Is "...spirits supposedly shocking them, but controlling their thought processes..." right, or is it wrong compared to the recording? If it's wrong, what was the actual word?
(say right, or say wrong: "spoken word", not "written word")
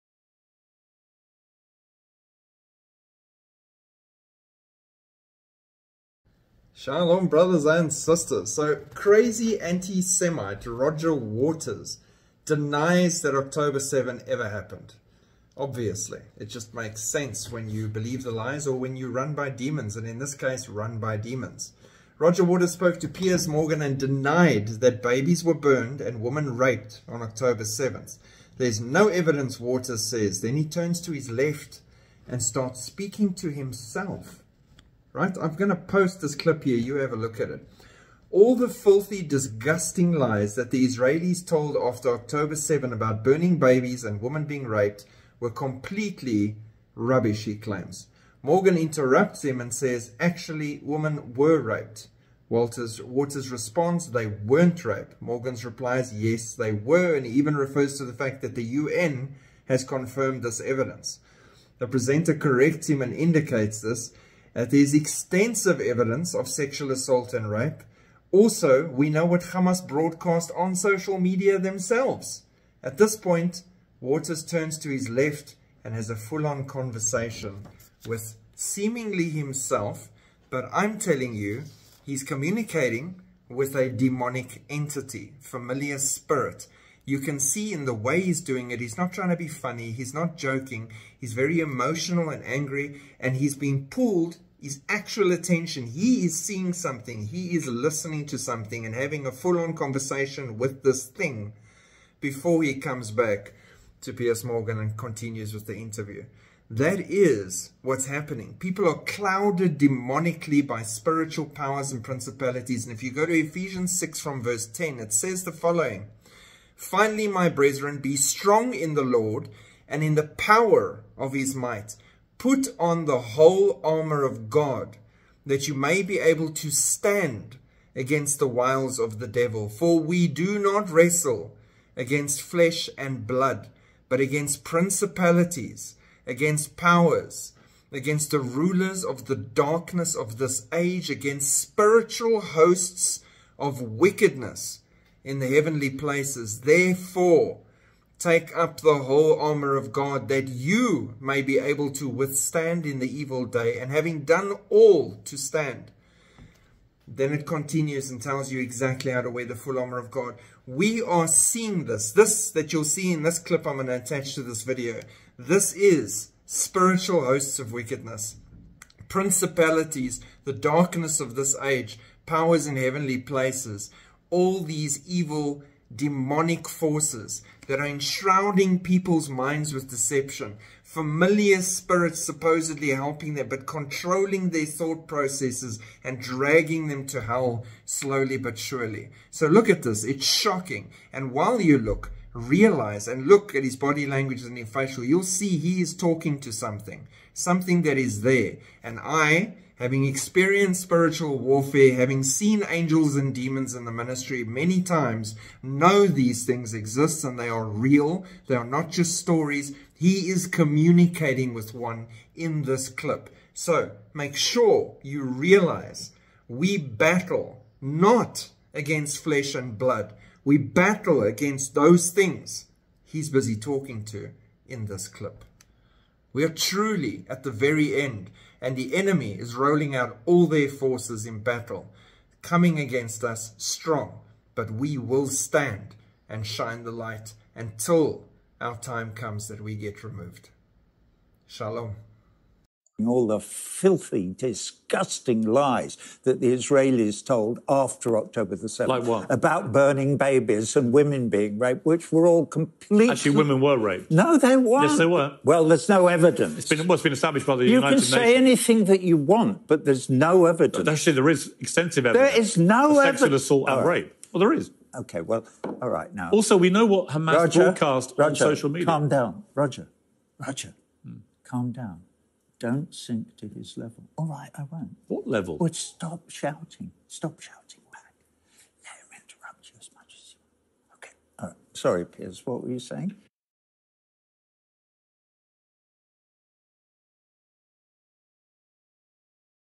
wrong: "helping", not "shocking".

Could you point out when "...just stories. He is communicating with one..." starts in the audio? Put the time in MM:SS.
03:28.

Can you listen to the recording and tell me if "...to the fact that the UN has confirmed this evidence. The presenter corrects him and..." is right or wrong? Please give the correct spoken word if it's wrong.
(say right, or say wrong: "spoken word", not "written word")
right.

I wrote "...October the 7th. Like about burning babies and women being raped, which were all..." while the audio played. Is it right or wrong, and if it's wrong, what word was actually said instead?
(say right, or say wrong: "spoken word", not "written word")
right.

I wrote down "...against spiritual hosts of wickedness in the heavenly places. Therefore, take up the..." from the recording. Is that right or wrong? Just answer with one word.
right.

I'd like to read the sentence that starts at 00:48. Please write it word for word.
Morgan interrupts him and says, actually, women were raped.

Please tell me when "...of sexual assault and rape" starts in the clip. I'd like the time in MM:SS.
01:06.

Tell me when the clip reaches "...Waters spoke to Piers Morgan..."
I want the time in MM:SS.
00:22.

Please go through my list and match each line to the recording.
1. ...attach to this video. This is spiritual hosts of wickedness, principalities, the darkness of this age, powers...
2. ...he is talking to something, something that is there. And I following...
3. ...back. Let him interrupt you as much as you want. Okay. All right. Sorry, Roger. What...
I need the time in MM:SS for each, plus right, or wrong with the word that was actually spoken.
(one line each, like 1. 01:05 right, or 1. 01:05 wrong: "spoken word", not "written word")
1. 02:43 right
2. 03:15 wrong: "having", not "following"
3. 04:37 wrong: "Piers", not "Roger".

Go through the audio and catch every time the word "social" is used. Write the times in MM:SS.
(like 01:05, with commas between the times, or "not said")
01:10, 04:28.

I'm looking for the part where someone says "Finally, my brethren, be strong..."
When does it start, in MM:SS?
01:56.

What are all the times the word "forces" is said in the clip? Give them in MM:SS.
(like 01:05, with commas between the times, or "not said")
02:56, 03:50.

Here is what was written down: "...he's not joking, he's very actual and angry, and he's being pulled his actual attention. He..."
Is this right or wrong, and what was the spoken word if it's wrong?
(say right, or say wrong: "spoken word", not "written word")
wrong: "emotional", not "actual".